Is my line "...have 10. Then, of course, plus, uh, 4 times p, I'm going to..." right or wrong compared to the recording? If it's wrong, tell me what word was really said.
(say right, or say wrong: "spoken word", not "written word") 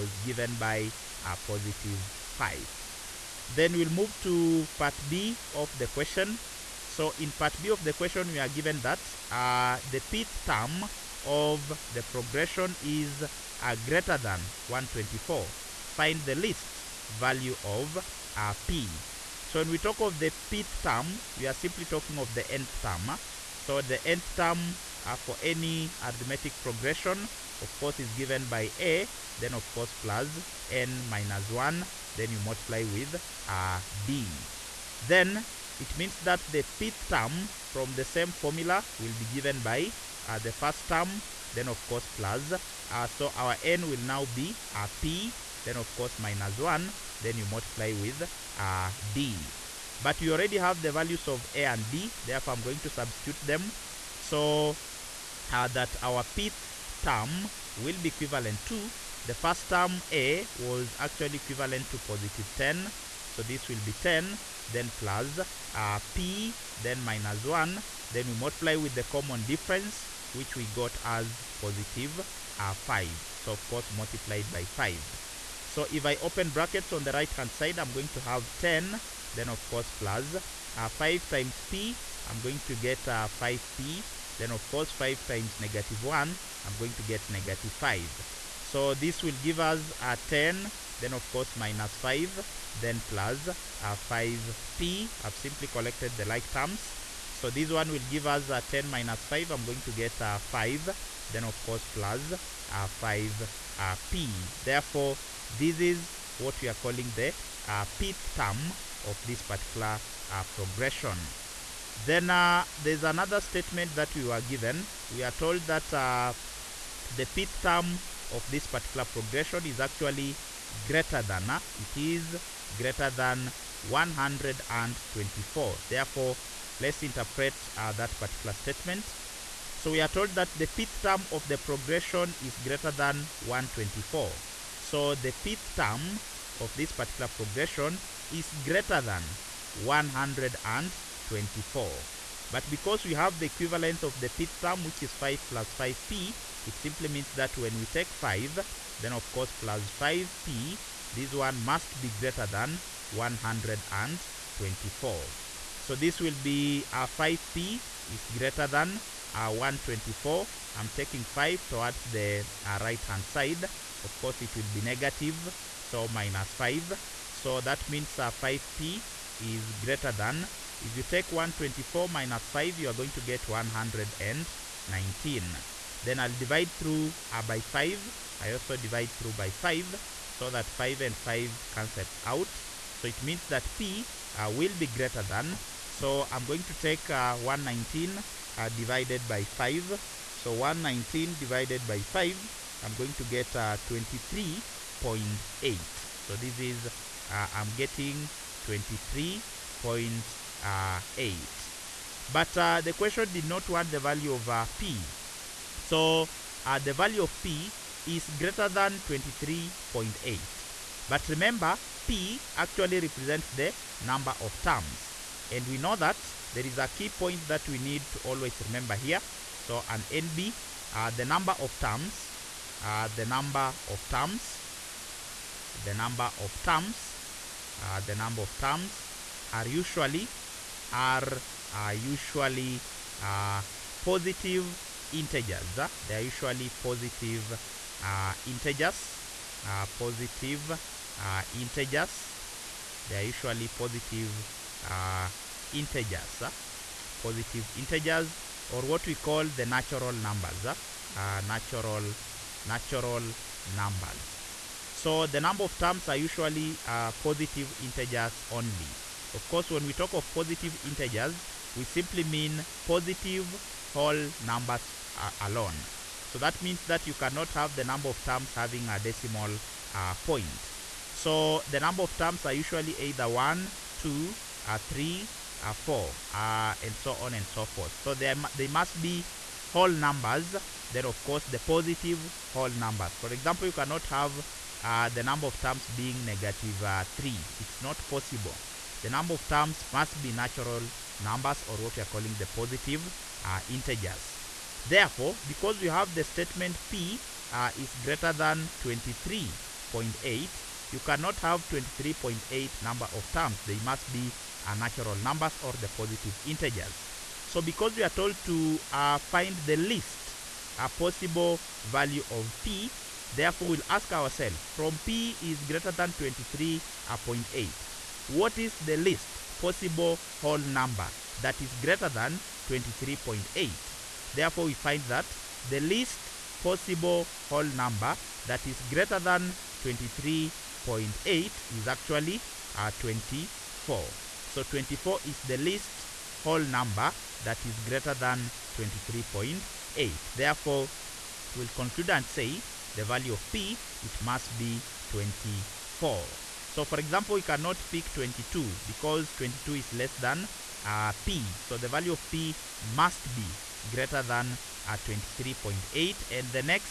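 wrong: "5", not "4".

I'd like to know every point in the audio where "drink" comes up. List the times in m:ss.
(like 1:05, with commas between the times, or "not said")
not said.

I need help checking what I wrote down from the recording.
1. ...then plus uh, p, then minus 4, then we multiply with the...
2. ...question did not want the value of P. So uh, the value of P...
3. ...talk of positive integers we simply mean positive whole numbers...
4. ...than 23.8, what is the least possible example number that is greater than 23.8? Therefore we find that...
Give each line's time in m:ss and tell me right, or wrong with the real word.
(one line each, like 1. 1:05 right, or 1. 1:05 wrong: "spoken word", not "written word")
1. 1:04 wrong: "1", not "4"
2. 3:22 right
3. 4:19 right
4. 5:15 wrong: "whole", not "example".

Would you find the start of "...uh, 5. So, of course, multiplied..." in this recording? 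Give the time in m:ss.
1:12.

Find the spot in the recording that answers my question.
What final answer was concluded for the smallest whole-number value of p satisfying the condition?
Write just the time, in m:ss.
5:44.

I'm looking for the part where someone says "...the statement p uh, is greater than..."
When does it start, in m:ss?
4:56.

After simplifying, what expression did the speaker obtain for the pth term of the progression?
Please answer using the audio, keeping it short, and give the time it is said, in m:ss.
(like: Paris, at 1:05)
5 + 5p, at 2:25.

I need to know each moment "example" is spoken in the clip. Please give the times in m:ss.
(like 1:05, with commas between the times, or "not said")
4:43, 5:46.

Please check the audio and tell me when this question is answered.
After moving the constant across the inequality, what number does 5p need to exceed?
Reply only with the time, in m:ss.
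2:52.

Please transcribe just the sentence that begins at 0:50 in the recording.
But we already have the values of a and d, therefore I'm going to substitute them.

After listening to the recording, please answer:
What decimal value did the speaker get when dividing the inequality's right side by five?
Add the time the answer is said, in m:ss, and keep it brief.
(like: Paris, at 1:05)
23.8, at 3:12.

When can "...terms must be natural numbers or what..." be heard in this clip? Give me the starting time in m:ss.
4:49.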